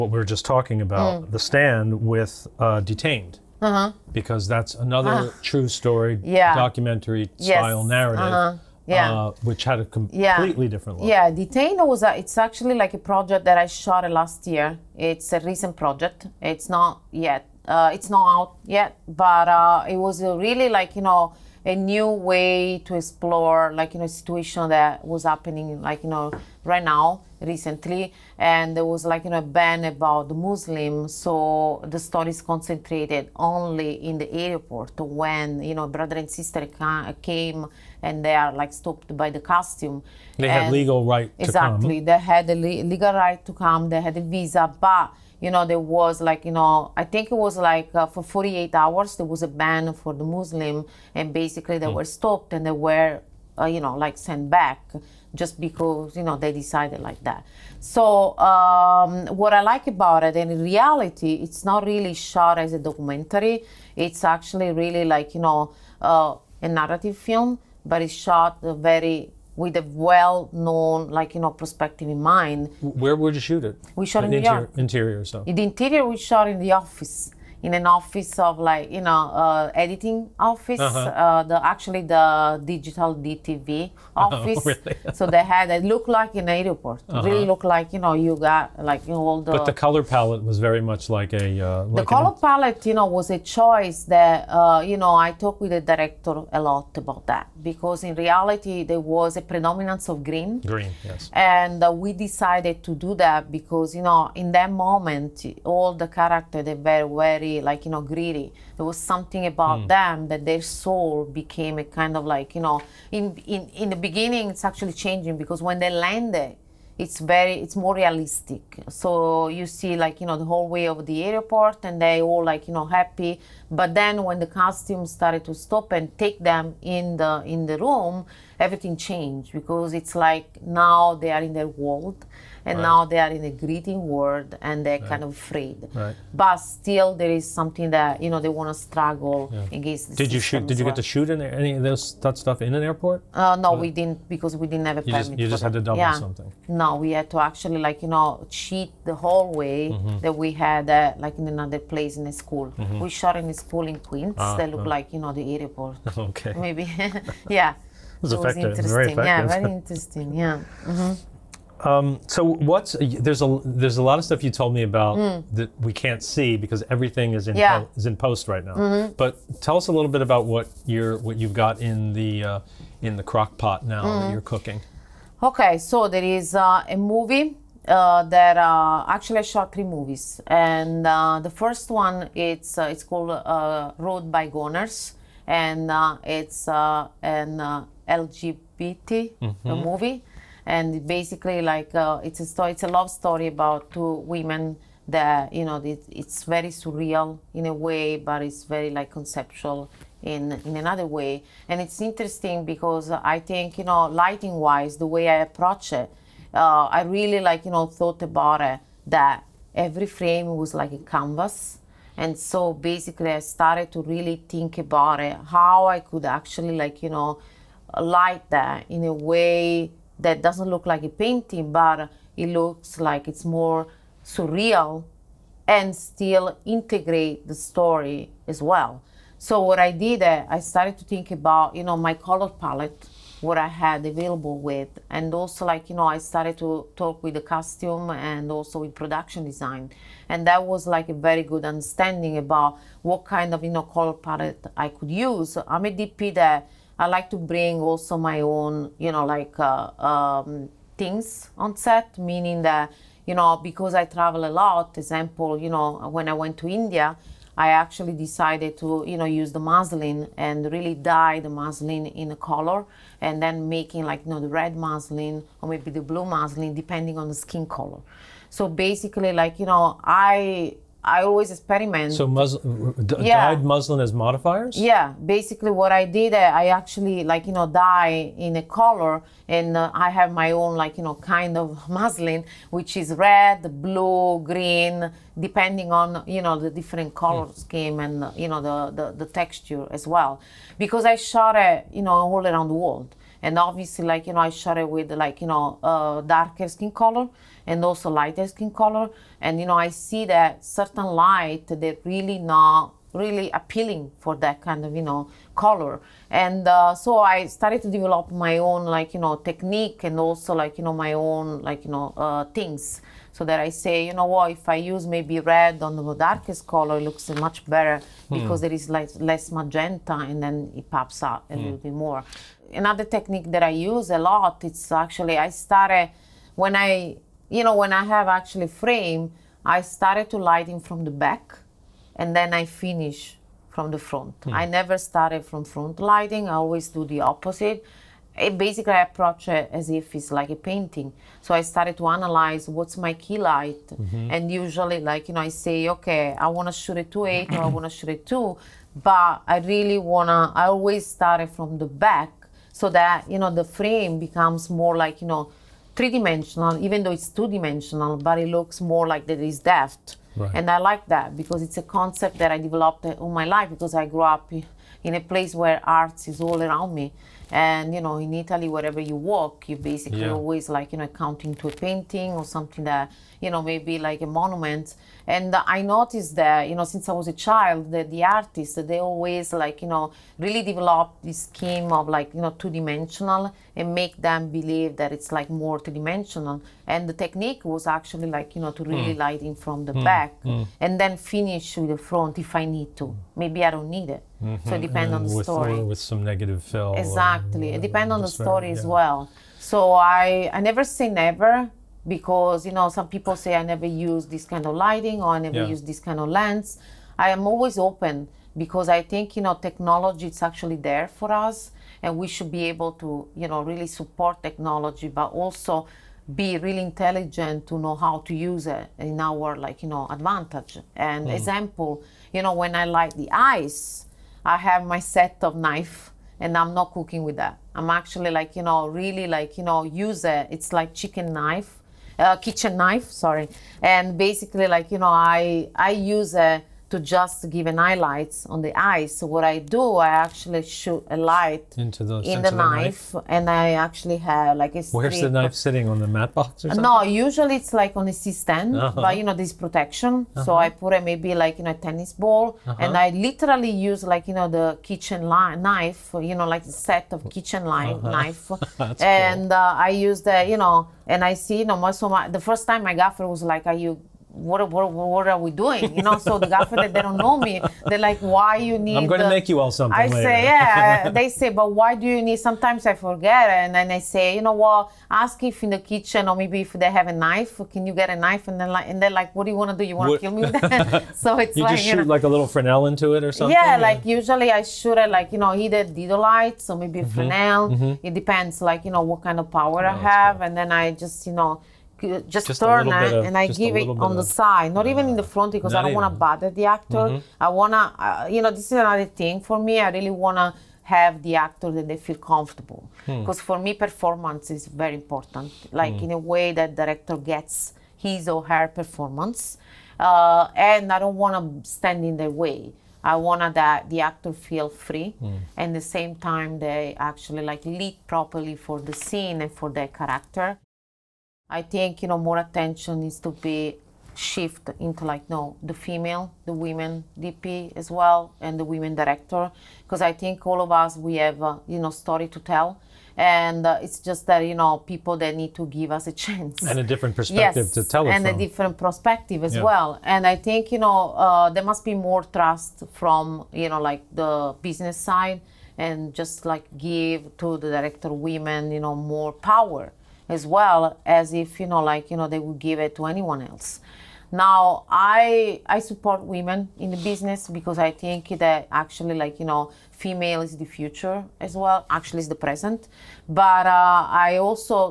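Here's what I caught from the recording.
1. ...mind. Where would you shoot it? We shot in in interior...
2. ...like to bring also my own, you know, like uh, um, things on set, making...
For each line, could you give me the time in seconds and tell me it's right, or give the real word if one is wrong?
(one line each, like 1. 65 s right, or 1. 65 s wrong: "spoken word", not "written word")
1. 72 s right
2. 247 s wrong: "meaning", not "making".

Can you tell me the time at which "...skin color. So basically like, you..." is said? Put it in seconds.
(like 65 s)
267 s.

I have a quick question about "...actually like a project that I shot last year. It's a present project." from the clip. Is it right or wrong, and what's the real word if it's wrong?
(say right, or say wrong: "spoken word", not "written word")
wrong: "recent", not "present".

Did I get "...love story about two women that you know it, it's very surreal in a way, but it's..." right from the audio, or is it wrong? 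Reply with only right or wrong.
right.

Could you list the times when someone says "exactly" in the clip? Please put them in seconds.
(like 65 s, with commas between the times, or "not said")
41 s, 396 s.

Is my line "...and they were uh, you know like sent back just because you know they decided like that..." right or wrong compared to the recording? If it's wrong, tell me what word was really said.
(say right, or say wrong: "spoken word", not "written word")
right.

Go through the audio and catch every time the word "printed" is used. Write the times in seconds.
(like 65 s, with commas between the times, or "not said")
not said.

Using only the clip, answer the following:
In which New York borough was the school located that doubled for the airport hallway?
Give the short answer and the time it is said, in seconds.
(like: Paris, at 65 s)
Queens, at 153 s.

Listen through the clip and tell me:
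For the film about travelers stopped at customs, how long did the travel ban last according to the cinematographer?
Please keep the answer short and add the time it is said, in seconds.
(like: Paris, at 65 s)
48 hours, at 48 s.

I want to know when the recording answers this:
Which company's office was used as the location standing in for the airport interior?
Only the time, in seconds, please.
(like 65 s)
83 s.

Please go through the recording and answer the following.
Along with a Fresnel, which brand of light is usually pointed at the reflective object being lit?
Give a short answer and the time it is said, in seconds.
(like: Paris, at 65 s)
Dedolight, at 485 s.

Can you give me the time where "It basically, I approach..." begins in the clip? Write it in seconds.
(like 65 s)
338 s.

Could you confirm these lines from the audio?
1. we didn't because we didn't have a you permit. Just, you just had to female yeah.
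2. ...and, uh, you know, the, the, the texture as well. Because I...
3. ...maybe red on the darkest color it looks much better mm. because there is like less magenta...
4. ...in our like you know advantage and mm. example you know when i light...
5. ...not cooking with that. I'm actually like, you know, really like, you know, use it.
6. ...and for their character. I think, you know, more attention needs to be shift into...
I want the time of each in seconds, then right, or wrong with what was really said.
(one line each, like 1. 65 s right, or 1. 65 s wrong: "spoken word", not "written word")
1. 143 s wrong: "double", not "female"
2. 288 s right
3. 315 s right
4. 418 s right
5. 426 s right
6. 519 s right.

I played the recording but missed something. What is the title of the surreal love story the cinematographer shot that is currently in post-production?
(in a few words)
Road of Bygones.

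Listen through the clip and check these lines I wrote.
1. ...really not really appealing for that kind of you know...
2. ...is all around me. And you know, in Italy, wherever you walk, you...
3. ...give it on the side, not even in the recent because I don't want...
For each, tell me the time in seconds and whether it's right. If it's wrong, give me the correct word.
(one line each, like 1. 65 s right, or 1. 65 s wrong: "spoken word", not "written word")
1. 302 s right
2. 366 s right
3. 493 s wrong: "front", not "recent".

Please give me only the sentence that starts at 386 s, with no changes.
And the technique was actually like you know to really mm.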